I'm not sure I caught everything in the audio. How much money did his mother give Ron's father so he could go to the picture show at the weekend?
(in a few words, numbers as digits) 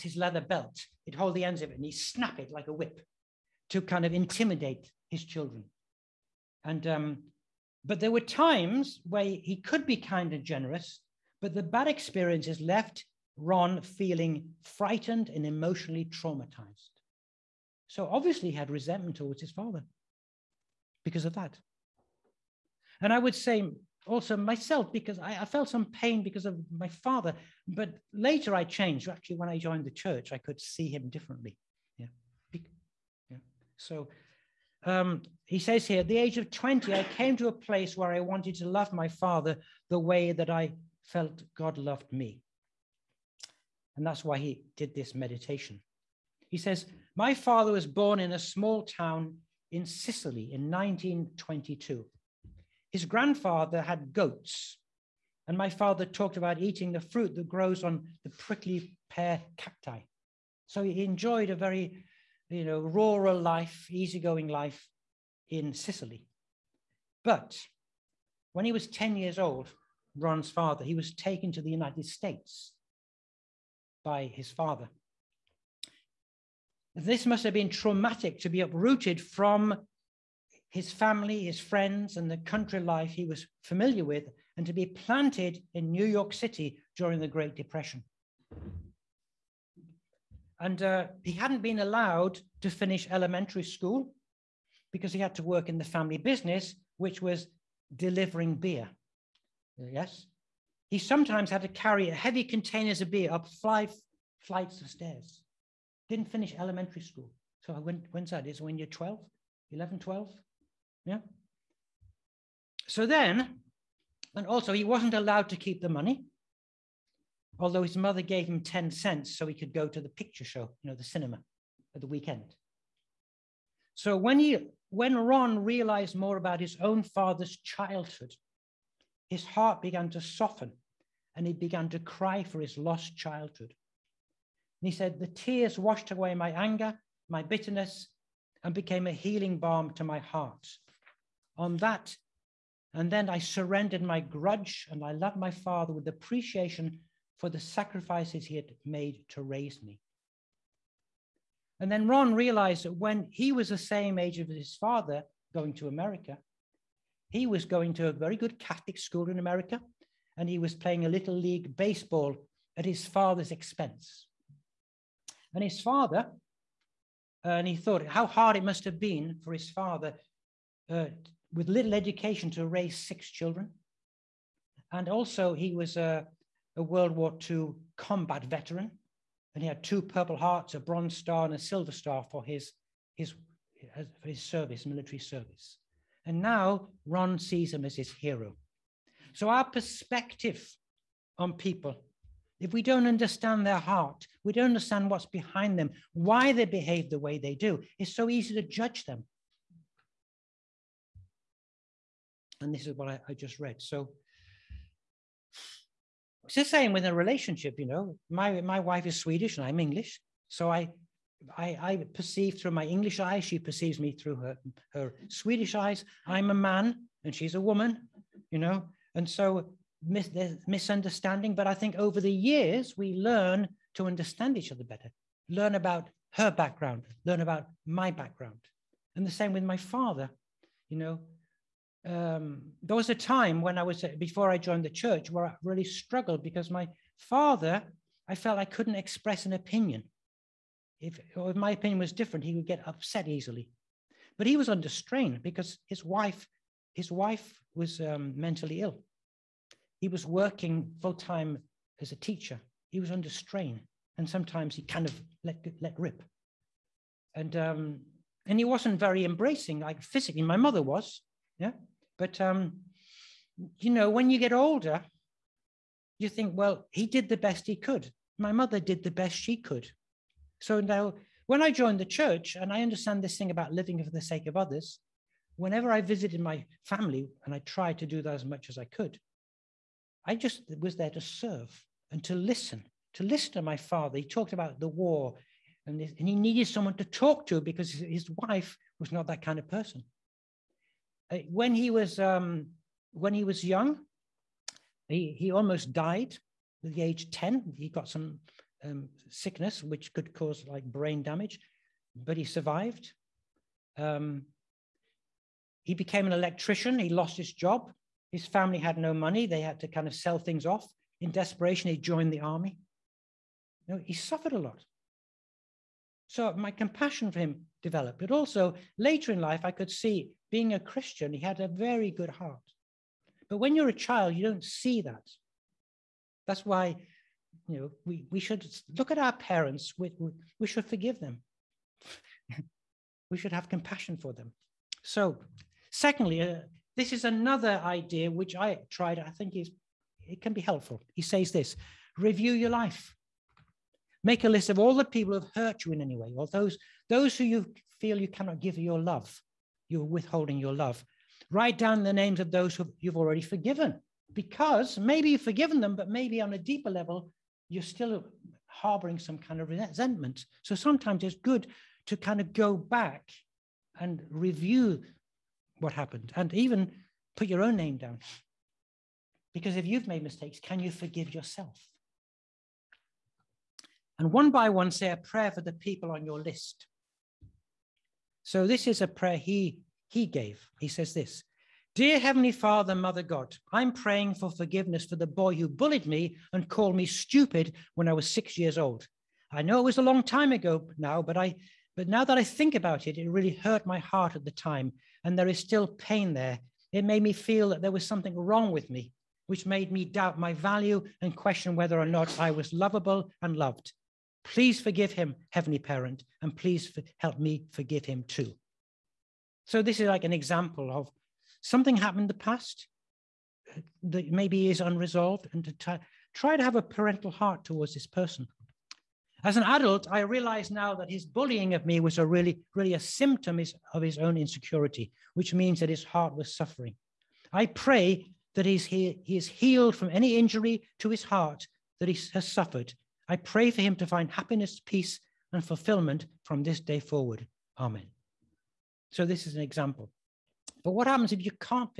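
10 cents.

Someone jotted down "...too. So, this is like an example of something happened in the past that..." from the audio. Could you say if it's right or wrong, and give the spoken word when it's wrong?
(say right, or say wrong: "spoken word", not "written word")
right.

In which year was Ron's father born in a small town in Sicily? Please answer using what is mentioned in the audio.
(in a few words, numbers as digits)
1922.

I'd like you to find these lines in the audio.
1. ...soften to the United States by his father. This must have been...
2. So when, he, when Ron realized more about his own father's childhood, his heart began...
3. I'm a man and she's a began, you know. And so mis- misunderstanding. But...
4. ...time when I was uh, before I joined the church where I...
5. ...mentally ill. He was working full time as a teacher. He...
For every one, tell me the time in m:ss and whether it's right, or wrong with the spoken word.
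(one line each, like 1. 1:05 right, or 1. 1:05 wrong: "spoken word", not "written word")
1. 1:11 wrong: "taken", not "soften"
2. 2:03 right
3. 3:36 wrong: "woman", not "began"
4. 3:53 right
5. 4:08 right.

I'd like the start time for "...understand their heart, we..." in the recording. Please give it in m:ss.
3:13.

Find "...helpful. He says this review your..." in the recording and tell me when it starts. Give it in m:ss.
5:40.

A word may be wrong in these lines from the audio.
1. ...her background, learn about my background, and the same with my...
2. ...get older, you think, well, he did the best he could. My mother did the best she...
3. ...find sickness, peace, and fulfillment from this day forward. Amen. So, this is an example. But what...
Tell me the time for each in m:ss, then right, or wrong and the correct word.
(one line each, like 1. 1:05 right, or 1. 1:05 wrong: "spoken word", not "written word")
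1. 3:46 right
2. 4:24 right
3. 7:14 wrong: "happiness", not "sickness".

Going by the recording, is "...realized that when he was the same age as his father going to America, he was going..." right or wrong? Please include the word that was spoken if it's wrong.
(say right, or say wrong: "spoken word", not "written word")
right.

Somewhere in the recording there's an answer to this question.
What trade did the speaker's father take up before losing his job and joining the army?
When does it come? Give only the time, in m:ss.
5:06.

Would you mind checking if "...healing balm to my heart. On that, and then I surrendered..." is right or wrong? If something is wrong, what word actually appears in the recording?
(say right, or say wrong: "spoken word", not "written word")
right.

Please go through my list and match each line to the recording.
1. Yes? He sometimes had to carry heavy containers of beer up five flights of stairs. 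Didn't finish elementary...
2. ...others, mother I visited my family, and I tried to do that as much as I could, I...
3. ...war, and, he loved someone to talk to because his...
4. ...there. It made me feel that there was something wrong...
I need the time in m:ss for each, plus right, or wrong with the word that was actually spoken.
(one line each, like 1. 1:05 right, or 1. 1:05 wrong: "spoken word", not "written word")
1. 1:39 right
2. 4:34 wrong: "whenever", not "mother"
3. 4:44 wrong: "needed", not "loved"
4. 6:36 right.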